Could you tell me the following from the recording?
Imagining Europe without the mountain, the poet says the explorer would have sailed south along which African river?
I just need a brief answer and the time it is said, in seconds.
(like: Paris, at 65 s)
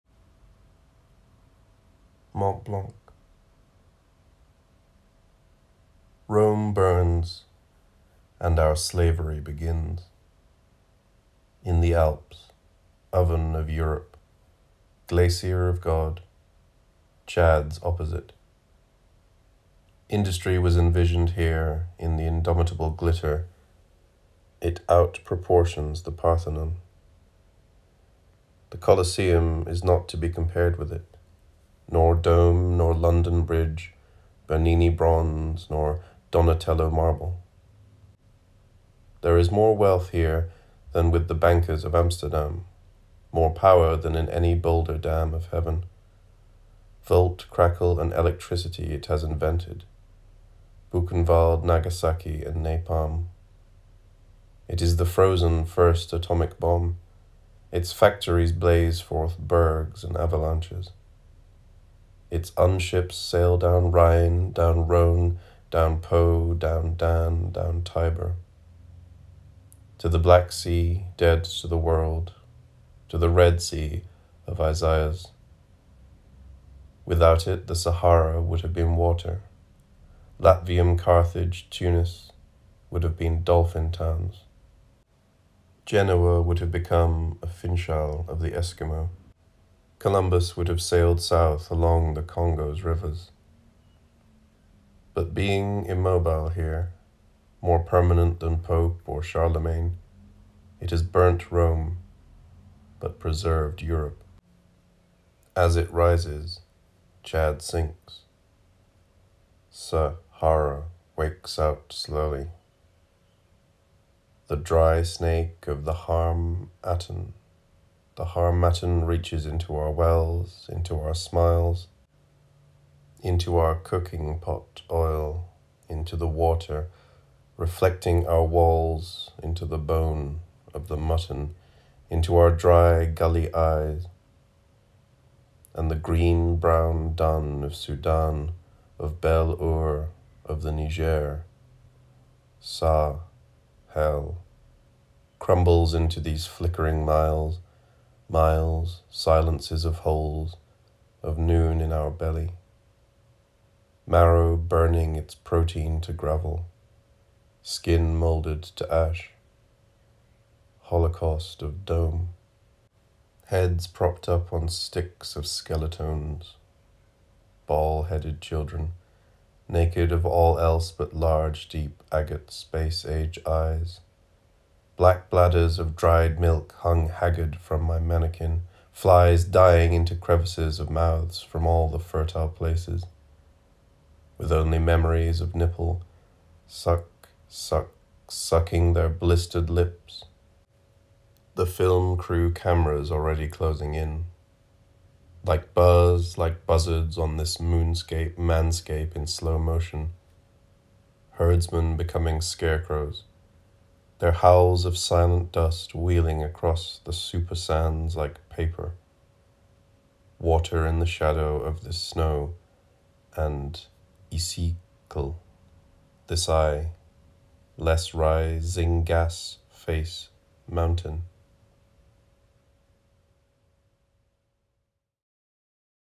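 Congo, at 92 s.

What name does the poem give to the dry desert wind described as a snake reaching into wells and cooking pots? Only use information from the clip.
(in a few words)
harmattan.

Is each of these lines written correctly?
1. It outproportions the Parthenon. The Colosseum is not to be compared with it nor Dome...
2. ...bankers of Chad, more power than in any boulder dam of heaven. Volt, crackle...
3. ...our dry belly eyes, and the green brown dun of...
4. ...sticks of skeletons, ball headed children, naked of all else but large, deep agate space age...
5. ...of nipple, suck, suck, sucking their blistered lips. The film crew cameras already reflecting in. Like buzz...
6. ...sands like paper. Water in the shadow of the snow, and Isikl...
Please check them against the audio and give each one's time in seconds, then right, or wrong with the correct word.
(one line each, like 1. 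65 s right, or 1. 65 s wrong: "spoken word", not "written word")
1. 24 s right
2. 41 s wrong: "Amsterdam", not "Chad"
3. 132 s wrong: "gully", not "belly"
4. 164 s right
5. 185 s wrong: "closing", not "reflecting"
6. 207 s right.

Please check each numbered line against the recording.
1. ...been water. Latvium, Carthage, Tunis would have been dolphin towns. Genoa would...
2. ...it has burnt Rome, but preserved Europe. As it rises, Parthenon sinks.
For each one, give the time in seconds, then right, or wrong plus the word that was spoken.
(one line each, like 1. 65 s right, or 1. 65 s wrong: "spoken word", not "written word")
1. 78 s right
2. 100 s wrong: "Chad", not "Parthenon".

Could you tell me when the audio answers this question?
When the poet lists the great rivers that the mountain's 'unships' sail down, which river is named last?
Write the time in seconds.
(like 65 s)
67 s.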